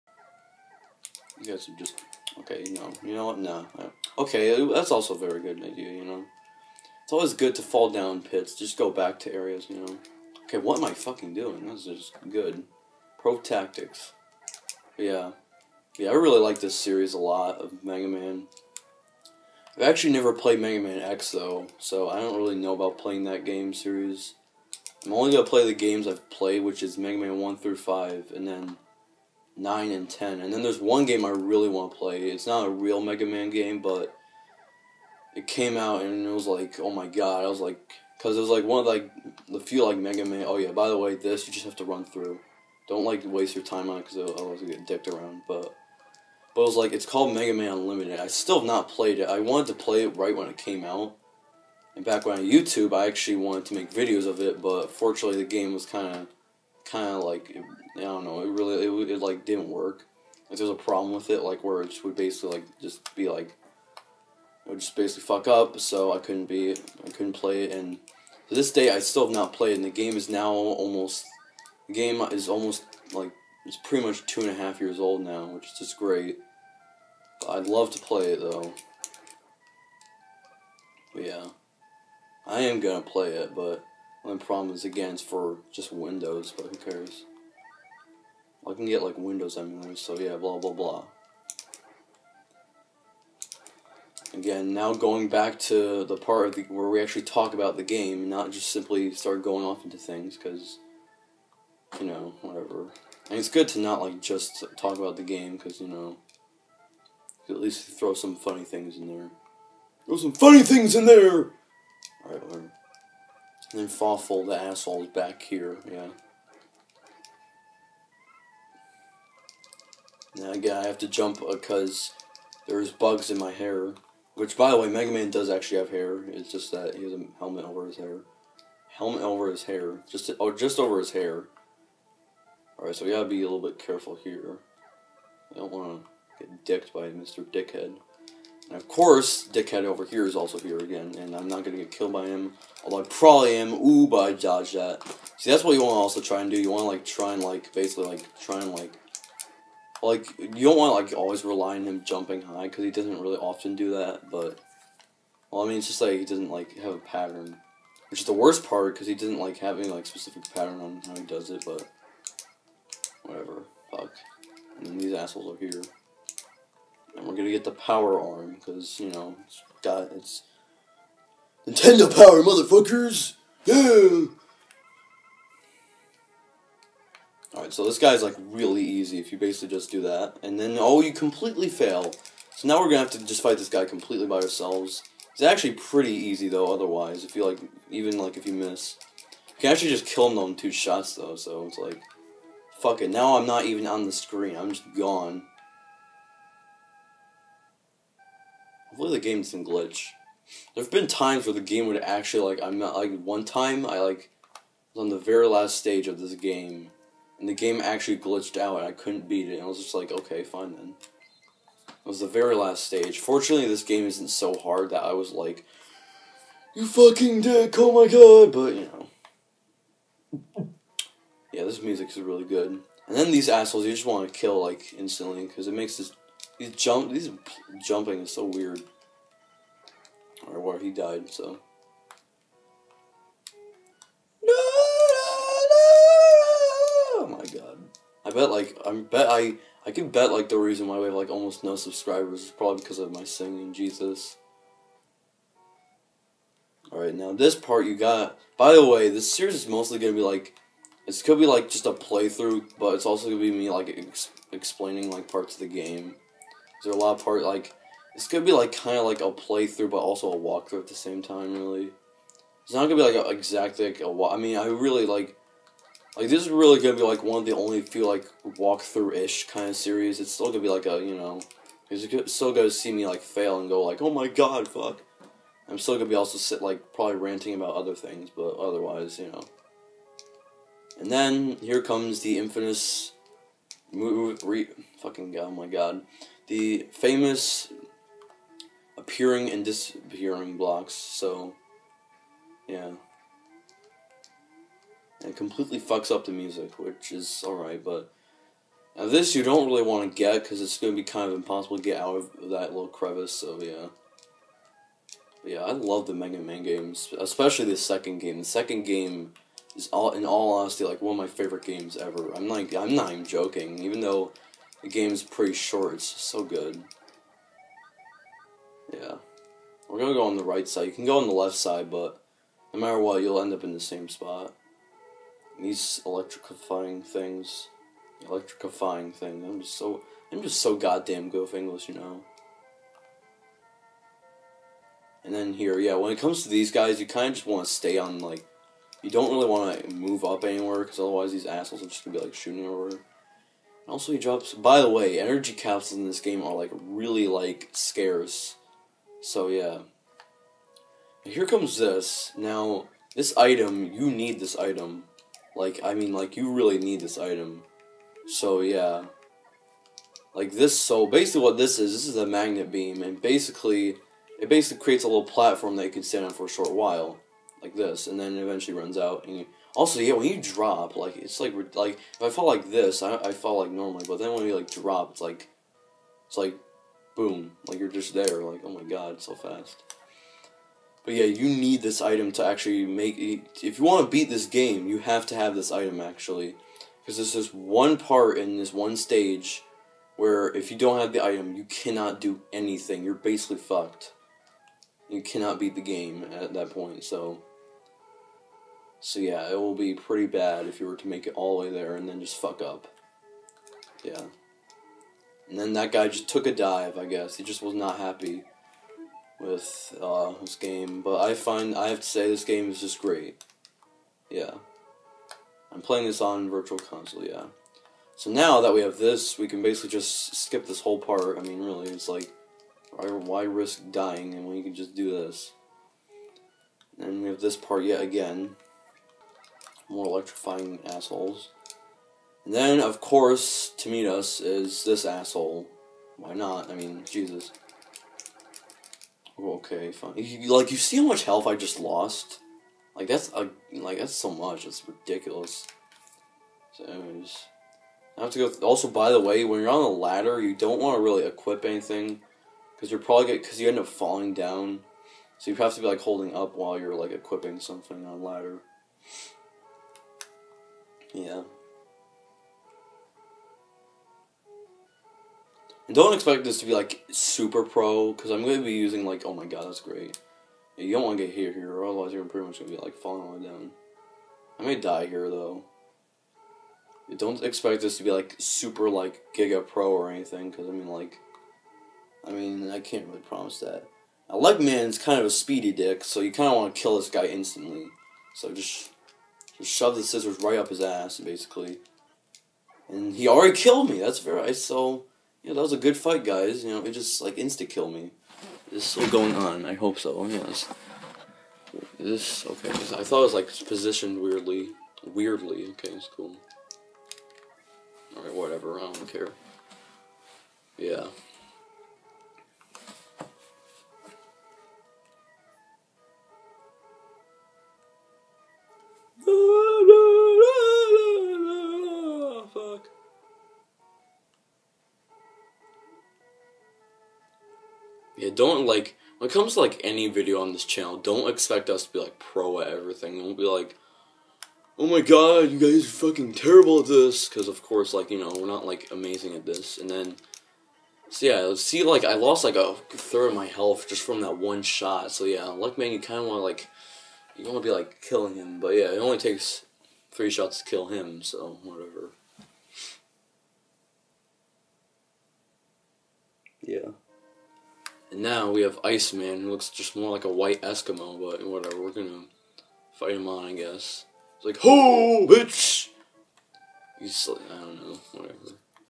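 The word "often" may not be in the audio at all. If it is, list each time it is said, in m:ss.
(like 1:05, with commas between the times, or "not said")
2:33.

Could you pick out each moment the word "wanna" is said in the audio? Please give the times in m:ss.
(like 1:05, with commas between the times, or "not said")
2:15.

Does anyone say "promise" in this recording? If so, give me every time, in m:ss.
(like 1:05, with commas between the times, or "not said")
8:03.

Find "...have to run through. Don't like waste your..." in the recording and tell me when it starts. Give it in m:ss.
0:41.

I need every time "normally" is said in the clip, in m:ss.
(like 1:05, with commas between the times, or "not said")
6:13.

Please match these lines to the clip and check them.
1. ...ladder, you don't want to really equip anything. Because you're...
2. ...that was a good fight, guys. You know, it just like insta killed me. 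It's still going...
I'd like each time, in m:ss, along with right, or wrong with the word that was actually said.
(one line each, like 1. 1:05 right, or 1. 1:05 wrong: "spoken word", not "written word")
1. 7:29 right
2. 8:15 right.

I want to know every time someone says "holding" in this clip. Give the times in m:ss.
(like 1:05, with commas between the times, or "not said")
7:36.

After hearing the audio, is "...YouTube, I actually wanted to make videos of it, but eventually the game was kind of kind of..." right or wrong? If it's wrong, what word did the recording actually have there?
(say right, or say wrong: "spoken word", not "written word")
wrong: "fortunately", not "eventually".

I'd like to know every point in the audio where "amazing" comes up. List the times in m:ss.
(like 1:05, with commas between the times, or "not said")
8:58.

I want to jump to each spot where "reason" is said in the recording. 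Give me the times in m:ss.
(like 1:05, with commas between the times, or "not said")
4:00.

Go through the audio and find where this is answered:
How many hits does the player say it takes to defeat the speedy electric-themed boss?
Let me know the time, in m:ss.
9:10.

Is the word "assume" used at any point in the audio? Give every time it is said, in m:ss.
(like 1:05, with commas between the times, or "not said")
not said.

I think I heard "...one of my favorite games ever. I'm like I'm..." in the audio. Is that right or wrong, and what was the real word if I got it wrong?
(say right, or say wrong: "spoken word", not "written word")
right.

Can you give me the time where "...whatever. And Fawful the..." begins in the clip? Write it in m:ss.
1:52.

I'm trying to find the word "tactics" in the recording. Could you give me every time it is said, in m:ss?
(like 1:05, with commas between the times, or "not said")
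0:13.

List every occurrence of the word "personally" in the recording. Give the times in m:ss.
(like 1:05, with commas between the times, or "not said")
not said.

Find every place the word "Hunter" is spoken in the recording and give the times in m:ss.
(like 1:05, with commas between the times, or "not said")
not said.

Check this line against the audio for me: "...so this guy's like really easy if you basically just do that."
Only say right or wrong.
right.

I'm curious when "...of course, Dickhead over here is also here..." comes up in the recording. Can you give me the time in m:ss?
2:18.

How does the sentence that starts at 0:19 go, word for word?
I've actually never played Mega Man X though, so I don't really know about playing that game series.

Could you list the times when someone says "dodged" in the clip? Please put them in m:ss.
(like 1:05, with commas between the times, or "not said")
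2:24.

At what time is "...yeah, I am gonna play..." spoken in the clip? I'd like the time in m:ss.
1:21.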